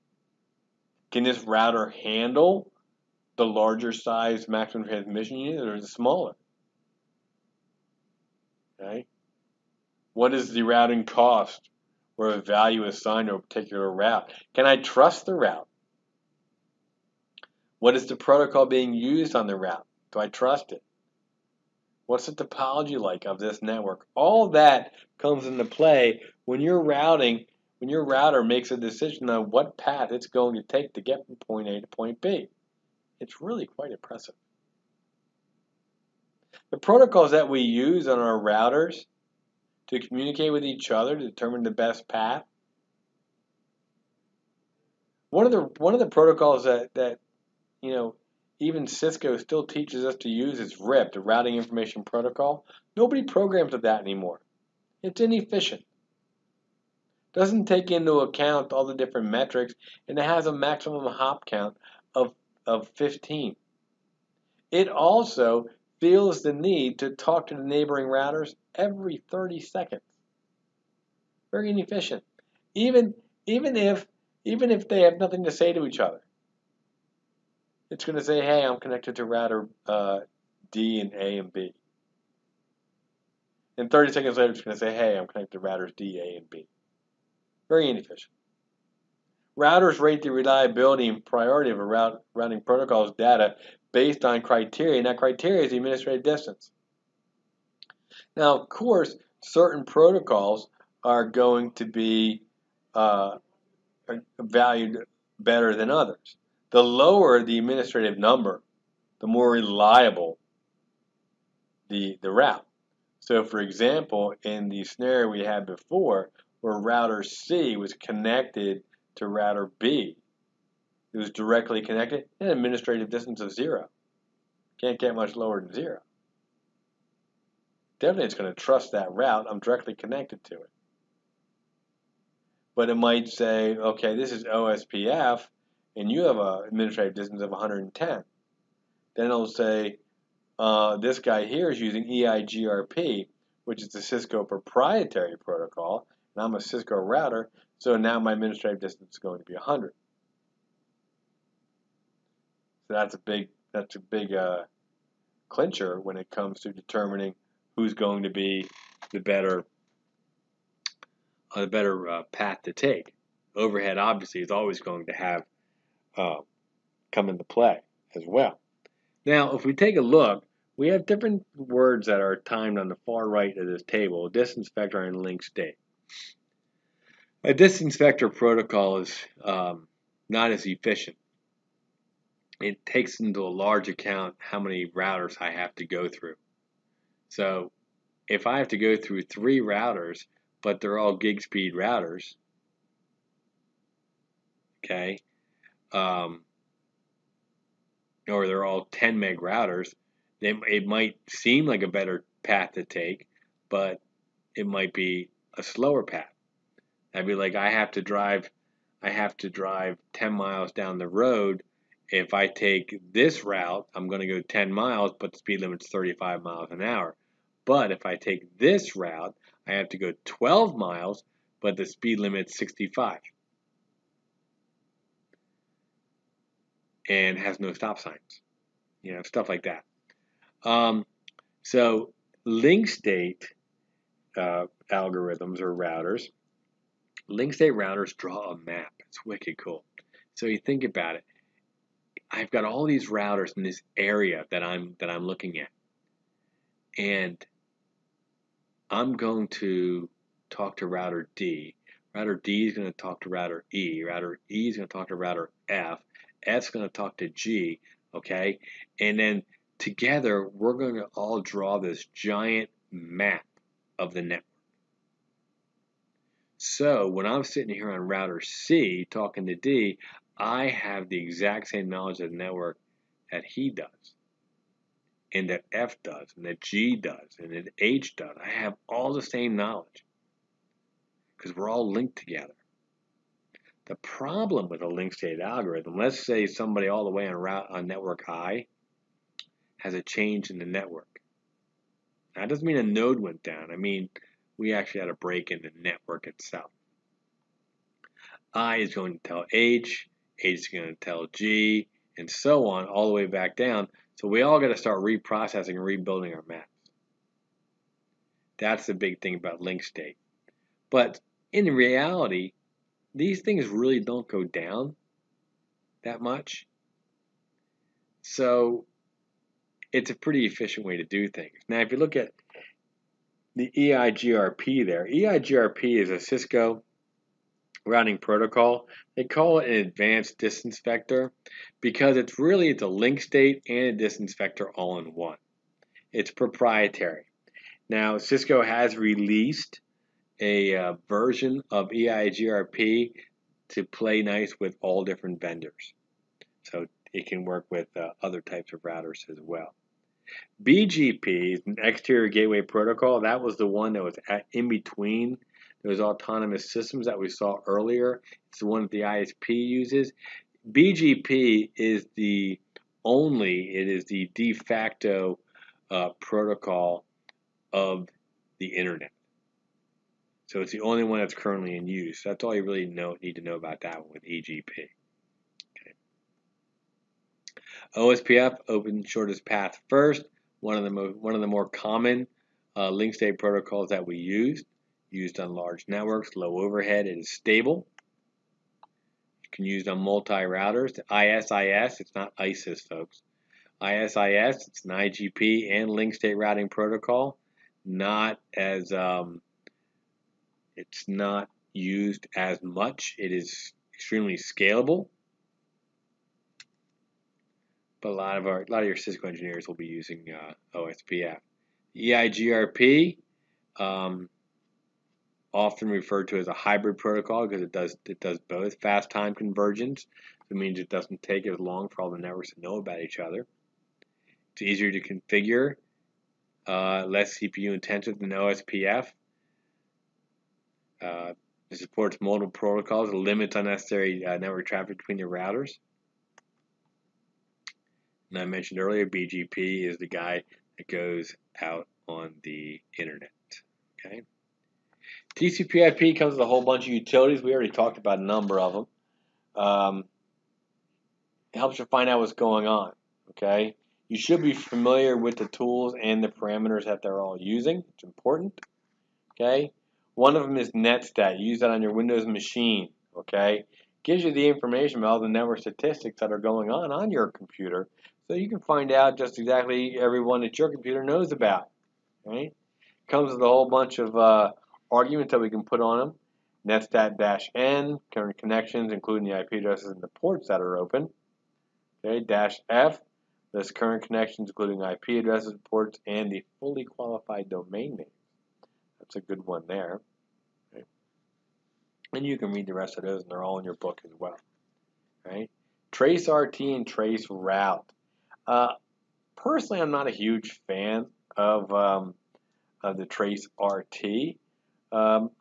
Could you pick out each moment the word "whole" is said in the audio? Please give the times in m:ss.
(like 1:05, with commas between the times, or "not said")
7:26, 7:53.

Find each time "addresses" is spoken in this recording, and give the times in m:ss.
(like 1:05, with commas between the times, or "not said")
7:59, 8:05.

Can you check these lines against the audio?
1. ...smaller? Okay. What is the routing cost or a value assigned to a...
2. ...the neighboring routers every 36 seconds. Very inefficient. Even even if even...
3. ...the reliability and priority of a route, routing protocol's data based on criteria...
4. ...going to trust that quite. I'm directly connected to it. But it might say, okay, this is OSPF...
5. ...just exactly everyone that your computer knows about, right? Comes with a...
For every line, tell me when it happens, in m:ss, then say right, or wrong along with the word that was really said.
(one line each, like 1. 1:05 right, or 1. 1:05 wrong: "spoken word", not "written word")
1. 0:05 right
2. 1:07 wrong: "30", not "36"
3. 1:30 right
4. 2:08 wrong: "route", not "quite"
5. 7:49 right.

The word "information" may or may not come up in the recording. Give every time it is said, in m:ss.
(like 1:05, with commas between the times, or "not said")
0:51, 7:44.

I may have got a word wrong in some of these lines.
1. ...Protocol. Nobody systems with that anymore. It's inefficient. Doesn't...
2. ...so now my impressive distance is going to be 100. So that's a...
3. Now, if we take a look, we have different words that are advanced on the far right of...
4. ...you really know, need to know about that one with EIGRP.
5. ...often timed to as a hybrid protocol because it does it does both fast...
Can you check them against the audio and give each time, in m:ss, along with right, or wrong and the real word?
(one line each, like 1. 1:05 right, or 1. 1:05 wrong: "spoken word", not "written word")
1. 0:52 wrong: "programs", not "systems"
2. 2:27 wrong: "administrative", not "impressive"
3. 2:49 wrong: "timed", not "advanced"
4. 6:12 wrong: "EGP", not "EIGRP"
5. 6:55 wrong: "referred", not "timed".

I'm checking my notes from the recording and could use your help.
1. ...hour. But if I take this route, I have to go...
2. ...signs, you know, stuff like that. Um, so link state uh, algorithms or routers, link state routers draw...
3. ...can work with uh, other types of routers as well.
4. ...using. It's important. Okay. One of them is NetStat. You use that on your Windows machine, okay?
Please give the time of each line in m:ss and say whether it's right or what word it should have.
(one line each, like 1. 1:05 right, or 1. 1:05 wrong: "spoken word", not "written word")
1. 3:36 right
2. 3:47 right
3. 5:47 right
4. 7:37 right.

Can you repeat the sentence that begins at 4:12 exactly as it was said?
Router D is going to talk to router E.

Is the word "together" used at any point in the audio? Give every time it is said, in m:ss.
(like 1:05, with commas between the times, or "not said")
4:19, 4:42.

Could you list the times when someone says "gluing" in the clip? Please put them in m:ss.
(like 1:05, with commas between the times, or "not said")
not said.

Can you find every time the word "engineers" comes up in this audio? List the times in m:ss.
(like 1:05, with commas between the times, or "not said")
6:49.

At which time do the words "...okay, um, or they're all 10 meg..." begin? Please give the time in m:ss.
3:14.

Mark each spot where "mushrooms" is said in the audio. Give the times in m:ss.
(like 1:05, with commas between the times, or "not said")
not said.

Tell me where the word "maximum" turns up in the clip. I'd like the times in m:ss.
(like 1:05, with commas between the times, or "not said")
0:04, 1:00.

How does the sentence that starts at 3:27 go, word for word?
I'd be like, I have to drive, I have to drive 10 miles down the road.